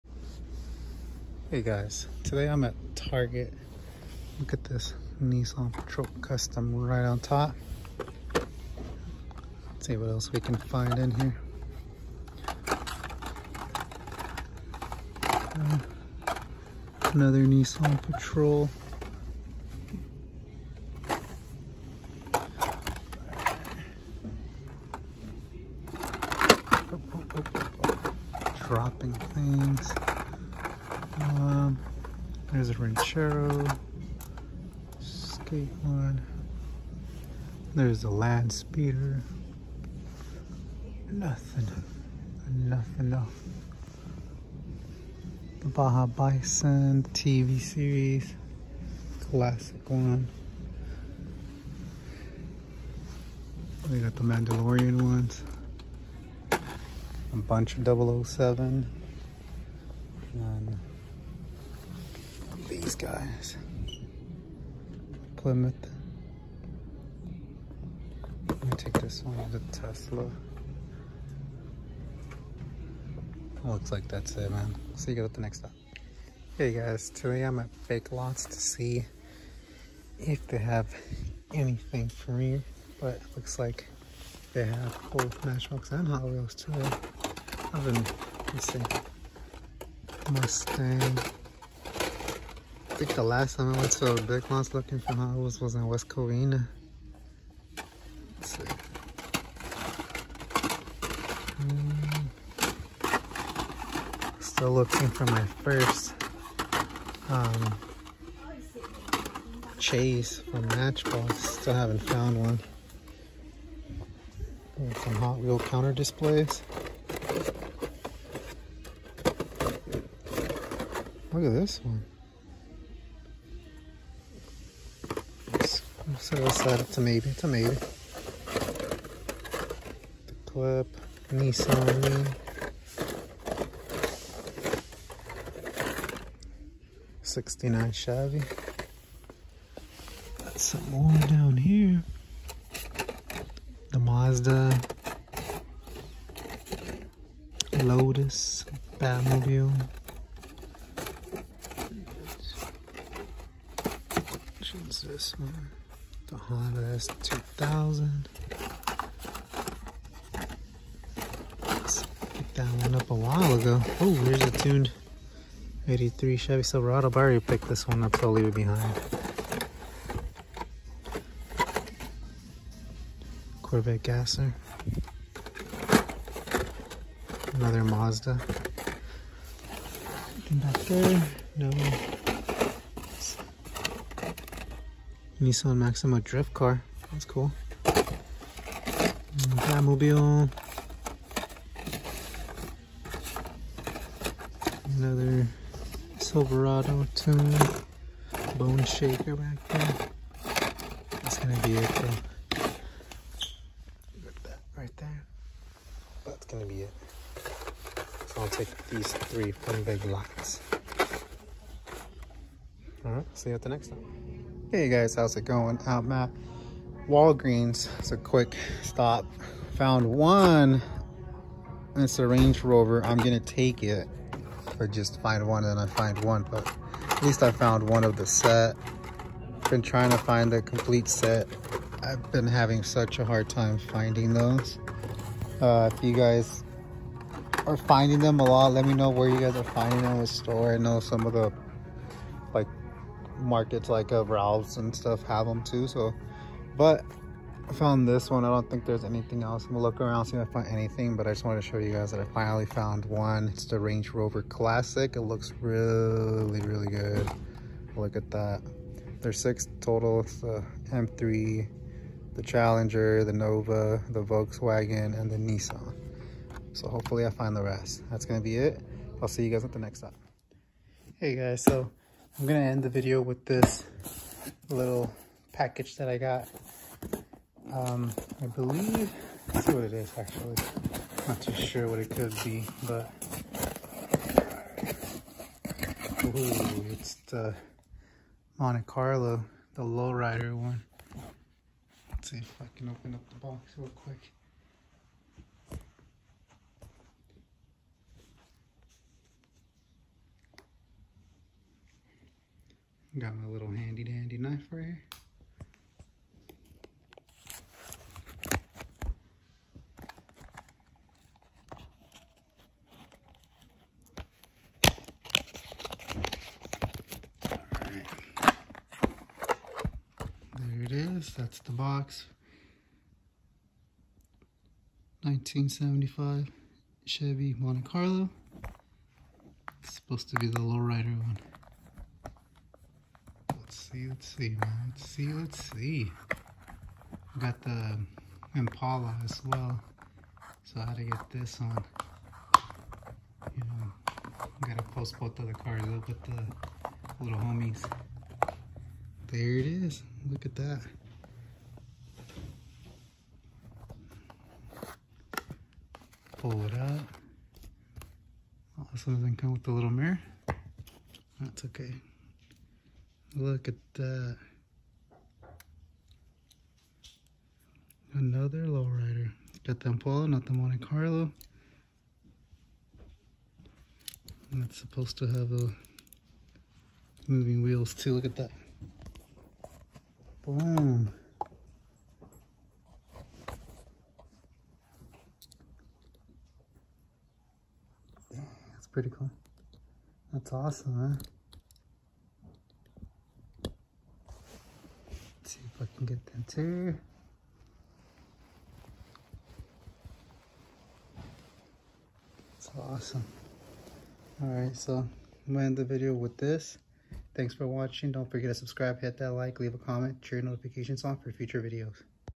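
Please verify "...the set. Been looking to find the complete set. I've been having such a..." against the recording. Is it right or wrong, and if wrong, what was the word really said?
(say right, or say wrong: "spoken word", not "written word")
wrong: "trying", not "looking".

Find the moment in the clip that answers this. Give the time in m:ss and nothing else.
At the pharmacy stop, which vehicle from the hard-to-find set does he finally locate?
4:13.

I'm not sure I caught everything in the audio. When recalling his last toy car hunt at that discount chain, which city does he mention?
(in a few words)
West Covina.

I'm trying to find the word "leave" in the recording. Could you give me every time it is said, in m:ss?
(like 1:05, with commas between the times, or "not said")
2:48, 6:49.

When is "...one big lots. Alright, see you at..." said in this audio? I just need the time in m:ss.
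3:29.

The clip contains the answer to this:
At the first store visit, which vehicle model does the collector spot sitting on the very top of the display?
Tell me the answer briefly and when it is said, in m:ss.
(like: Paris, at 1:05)
Nissan Patrol Custom, at 0:05.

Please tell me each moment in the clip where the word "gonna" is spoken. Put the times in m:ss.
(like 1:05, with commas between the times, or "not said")
3:21, 3:26, 3:43, 4:09, 4:28, 4:32, 6:45.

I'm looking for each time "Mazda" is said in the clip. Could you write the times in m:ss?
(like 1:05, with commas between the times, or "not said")
2:23, 2:57.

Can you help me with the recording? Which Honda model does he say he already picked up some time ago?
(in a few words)
Honda S2000.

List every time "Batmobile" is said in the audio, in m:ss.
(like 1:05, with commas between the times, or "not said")
2:28, 3:09.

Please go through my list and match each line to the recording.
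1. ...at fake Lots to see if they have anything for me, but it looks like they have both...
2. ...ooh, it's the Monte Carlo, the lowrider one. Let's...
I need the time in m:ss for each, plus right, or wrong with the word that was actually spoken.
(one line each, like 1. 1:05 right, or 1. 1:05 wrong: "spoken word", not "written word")
1. 1:17 right
2. 4:46 right.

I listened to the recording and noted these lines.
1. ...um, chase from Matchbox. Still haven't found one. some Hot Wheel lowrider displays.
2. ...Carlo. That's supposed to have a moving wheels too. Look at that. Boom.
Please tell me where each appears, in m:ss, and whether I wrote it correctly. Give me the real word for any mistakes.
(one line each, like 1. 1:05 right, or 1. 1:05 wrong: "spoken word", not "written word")
1. 1:47 wrong: "counter", not "lowrider"
2. 6:10 right.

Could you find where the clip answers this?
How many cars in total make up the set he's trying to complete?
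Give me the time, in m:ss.
4:19.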